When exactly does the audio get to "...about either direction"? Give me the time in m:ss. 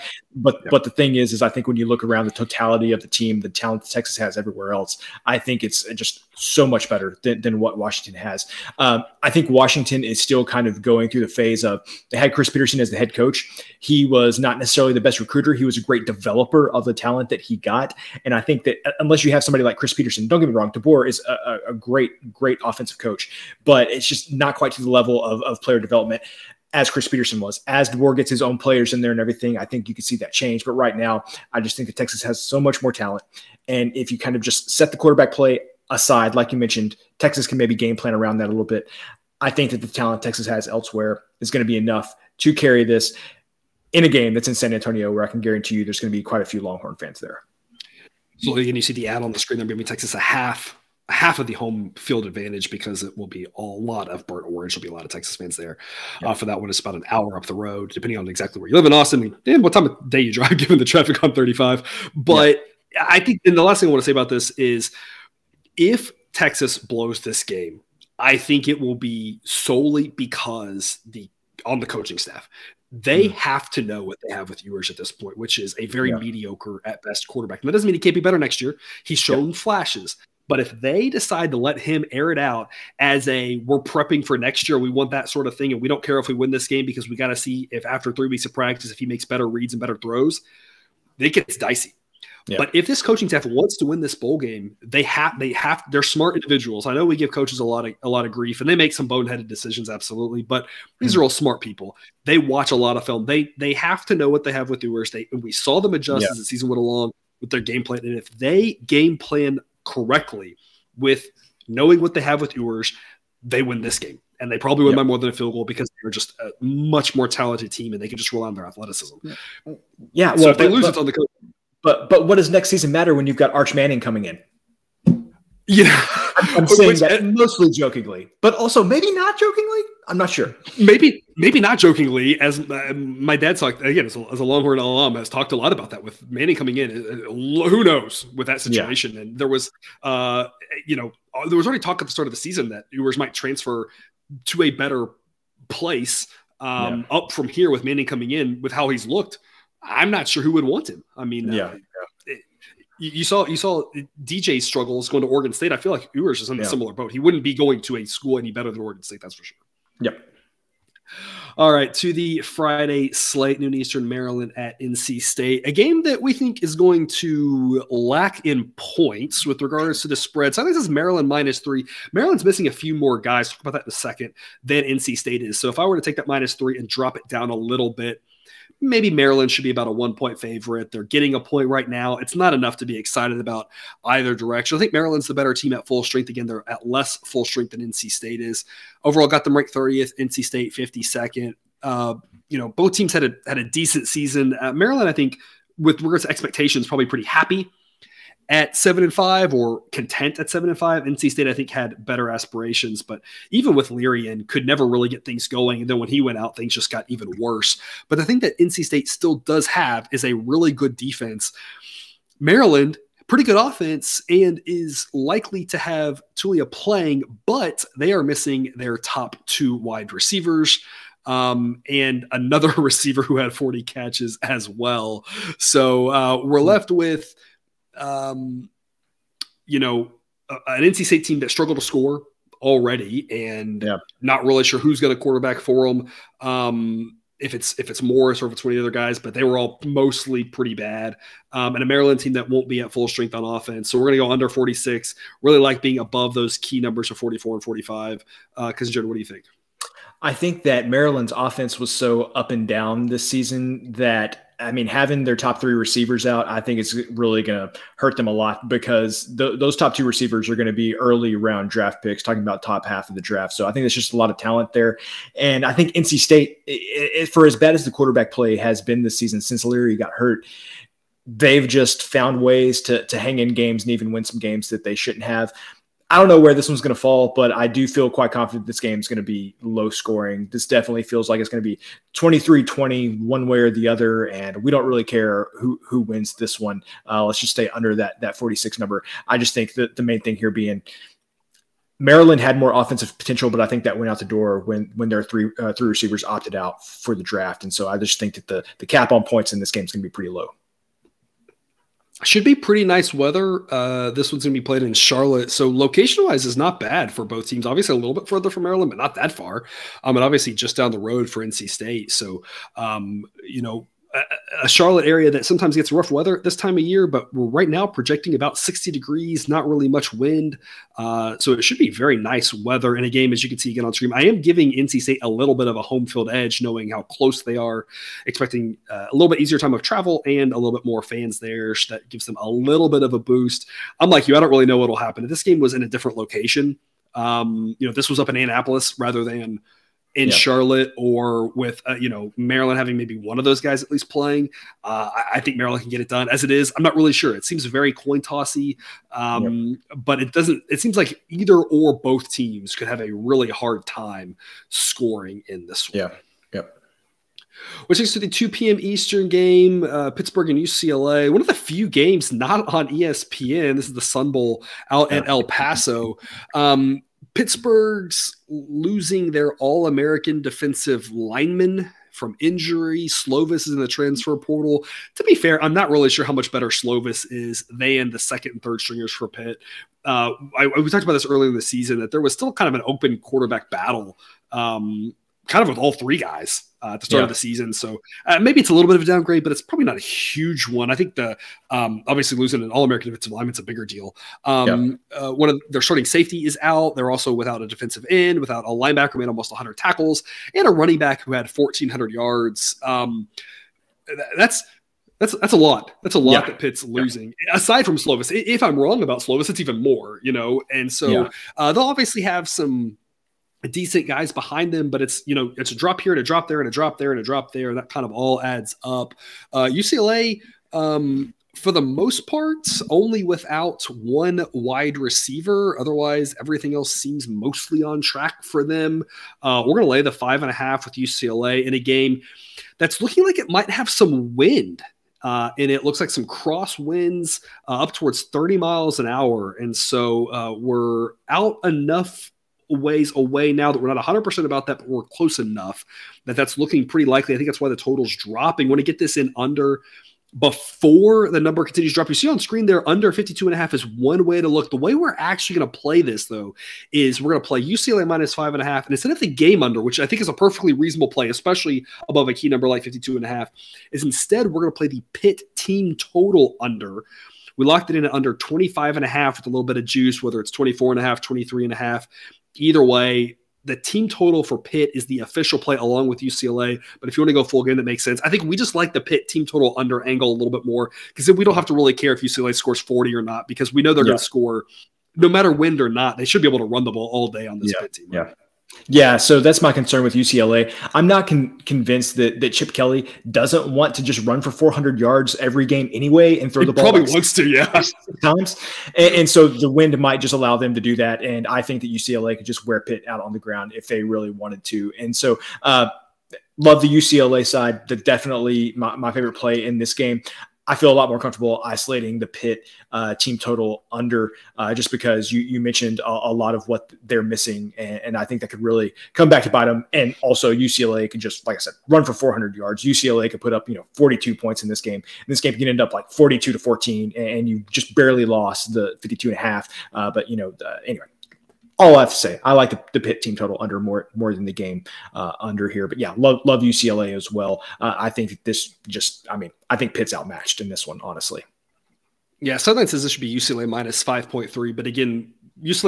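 3:03.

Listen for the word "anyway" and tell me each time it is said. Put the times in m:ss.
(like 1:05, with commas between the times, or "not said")
8:15, 8:50.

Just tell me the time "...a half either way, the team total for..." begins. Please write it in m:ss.
7:51.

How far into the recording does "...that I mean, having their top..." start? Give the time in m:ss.
4:13.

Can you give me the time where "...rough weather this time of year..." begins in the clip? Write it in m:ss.
5:15.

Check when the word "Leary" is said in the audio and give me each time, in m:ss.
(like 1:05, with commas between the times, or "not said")
3:23, 4:29.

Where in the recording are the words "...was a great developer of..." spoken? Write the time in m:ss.
0:15.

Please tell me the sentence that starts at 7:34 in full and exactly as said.
The way we're actually going to play this, though, is we're going to play UCLA minus five and a half.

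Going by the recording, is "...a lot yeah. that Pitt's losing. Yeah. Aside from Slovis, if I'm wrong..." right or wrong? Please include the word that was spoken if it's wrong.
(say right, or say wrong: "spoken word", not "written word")
right.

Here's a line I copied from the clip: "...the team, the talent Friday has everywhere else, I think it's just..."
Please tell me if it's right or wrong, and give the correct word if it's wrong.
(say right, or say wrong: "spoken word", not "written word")
wrong: "Texas", not "Friday".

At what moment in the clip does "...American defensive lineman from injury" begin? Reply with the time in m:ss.
6:09.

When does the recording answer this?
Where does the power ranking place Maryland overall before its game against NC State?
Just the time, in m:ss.
3:09.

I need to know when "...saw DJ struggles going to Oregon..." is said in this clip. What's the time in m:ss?
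2:33.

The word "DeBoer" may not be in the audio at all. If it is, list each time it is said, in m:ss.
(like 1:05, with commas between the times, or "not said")
0:20, 0:27.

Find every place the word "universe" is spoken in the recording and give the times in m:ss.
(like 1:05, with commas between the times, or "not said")
not said.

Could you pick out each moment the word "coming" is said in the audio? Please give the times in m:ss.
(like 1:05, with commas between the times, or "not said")
2:03, 2:16, 2:28.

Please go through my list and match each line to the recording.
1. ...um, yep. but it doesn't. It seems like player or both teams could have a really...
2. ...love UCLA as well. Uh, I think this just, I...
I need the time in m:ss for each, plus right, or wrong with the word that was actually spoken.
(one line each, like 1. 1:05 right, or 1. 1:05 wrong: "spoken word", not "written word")
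1. 5:49 wrong: "either", not "player"
2. 8:56 right.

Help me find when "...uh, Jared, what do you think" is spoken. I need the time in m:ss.
4:08.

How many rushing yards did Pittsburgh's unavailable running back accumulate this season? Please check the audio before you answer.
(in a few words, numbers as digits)
1,400.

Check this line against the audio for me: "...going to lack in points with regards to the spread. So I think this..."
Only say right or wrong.
right.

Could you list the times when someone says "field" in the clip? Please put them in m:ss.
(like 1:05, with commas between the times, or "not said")
0:51, 1:55, 5:26.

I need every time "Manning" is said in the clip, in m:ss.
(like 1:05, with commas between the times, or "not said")
2:03, 2:16, 2:27.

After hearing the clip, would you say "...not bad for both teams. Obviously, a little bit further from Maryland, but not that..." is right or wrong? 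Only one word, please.
right.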